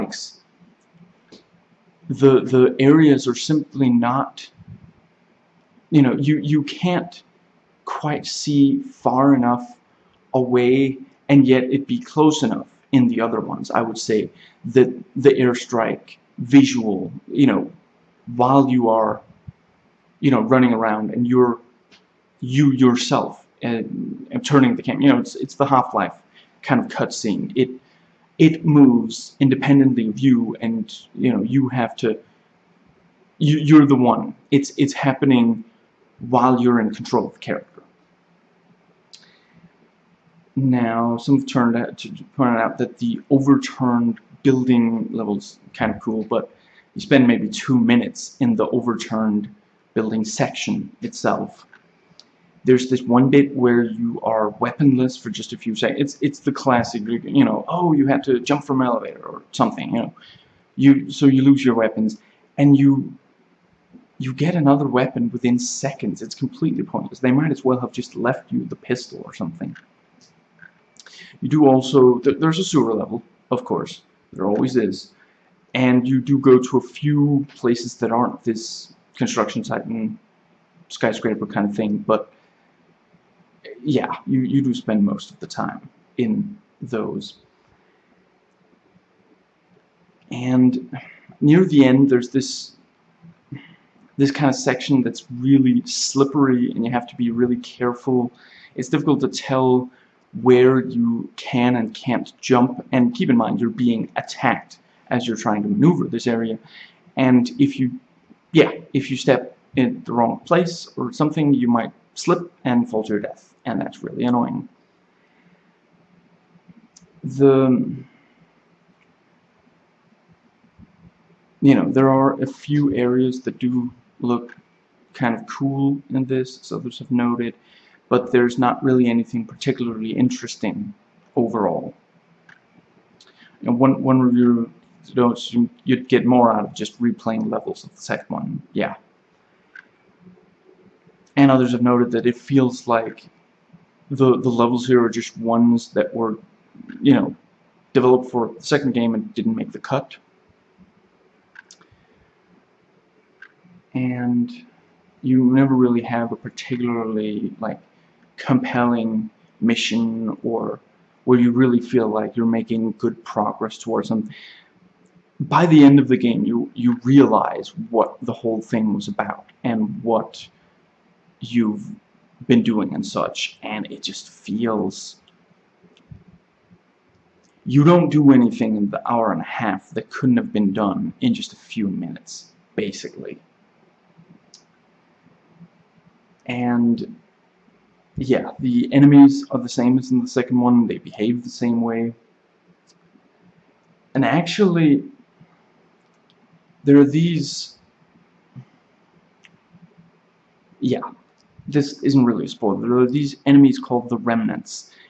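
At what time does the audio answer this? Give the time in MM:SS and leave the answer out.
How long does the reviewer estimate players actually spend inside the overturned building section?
00:47.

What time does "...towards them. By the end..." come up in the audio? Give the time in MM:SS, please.
02:43.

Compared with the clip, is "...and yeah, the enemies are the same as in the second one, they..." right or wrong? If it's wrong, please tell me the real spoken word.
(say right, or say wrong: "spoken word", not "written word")
right.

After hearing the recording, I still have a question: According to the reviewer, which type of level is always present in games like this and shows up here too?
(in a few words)
Sewer level.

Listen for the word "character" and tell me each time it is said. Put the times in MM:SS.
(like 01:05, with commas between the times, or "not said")
00:37.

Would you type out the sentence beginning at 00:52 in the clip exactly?
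There's this one bit where you are weaponless for just a few seconds.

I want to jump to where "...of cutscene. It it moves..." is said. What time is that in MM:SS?
00:26.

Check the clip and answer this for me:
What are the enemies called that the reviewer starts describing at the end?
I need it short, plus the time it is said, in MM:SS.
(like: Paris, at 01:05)
The Remnants, at 03:24.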